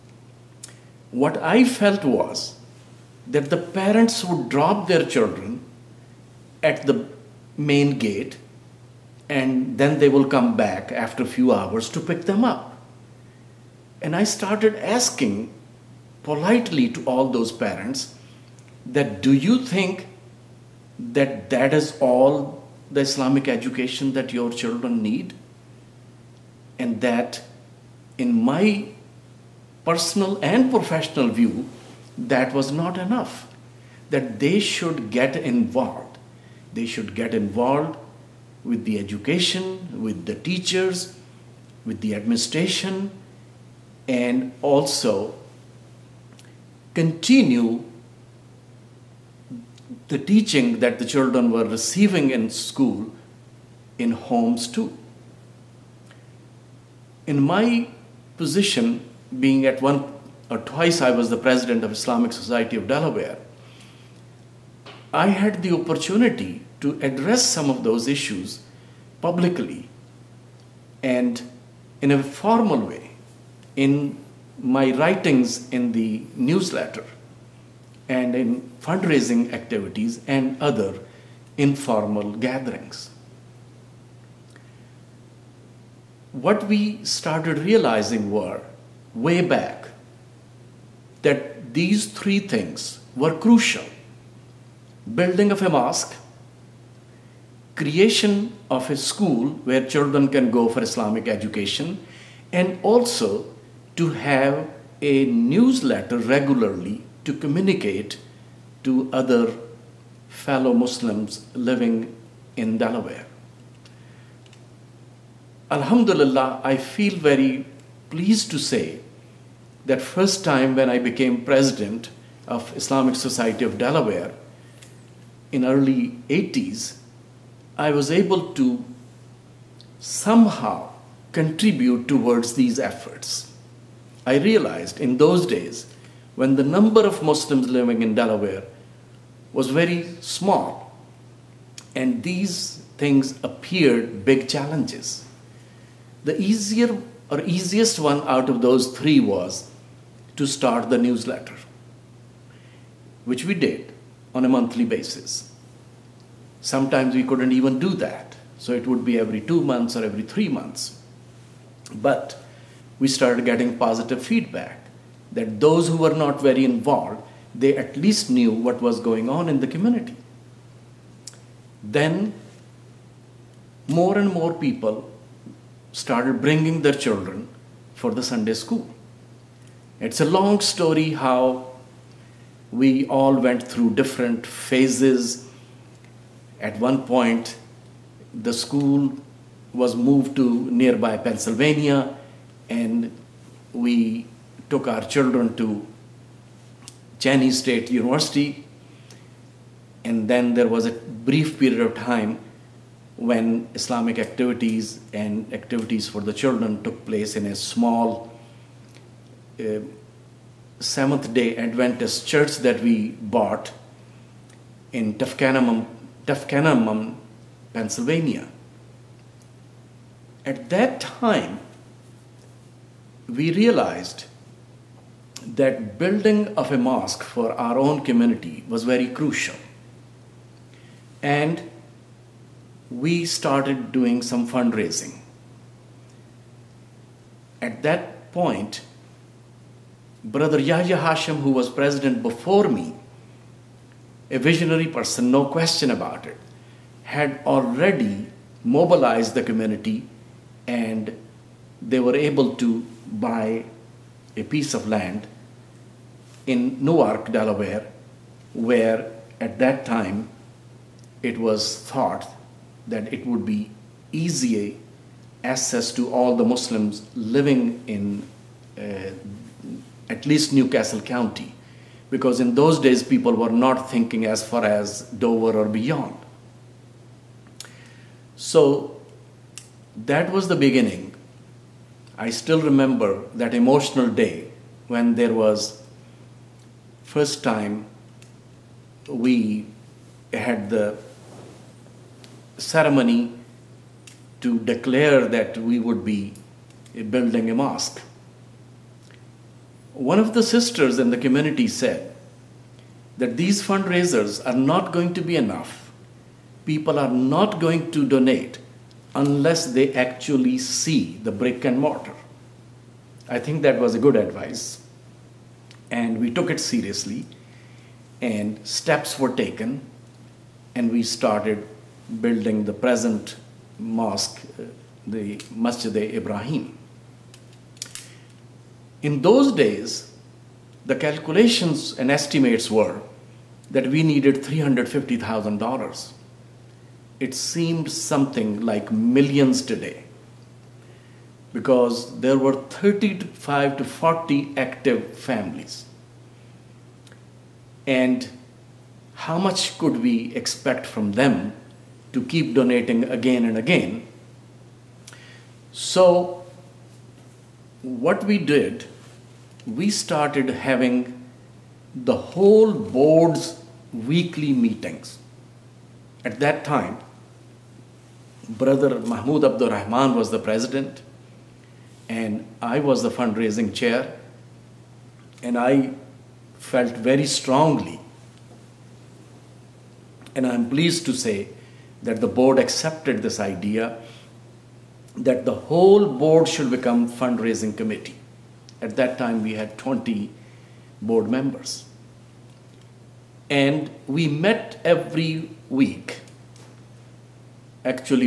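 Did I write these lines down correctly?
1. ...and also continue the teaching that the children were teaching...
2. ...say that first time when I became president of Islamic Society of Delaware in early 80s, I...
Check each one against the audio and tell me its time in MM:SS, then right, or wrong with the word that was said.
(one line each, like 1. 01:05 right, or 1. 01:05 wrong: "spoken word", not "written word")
1. 00:44 wrong: "receiving", not "teaching"
2. 01:58 right.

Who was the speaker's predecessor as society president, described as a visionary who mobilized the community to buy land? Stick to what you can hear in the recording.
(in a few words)
Yahya Hashim.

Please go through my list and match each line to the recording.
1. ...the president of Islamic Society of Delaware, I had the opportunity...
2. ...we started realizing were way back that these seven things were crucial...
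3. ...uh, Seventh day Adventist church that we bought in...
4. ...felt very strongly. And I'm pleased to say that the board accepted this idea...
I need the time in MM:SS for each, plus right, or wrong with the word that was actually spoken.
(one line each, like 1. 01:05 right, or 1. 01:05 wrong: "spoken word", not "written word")
1. 01:01 right
2. 01:26 wrong: "three", not "seven"
3. 03:29 right
4. 06:16 right.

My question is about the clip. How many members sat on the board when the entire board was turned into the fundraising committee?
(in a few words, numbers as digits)
20.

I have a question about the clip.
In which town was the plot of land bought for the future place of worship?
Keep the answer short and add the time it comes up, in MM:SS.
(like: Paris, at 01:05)
Newark, Delaware, at 04:16.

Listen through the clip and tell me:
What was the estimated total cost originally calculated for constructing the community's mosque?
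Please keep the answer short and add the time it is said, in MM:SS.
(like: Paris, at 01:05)
$350,000, at 05:34.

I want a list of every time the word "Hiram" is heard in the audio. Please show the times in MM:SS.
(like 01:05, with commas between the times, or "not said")
not said.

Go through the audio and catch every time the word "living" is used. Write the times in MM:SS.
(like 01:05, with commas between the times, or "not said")
01:51, 02:17, 04:27.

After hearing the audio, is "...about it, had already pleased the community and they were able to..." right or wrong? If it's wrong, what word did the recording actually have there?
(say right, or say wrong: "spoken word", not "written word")
wrong: "mobilized", not "pleased".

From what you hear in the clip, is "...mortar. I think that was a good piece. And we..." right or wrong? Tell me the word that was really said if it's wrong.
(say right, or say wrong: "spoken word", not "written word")
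wrong: "advice", not "piece".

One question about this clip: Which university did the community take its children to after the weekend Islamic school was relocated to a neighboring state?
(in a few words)
Cheyney State University.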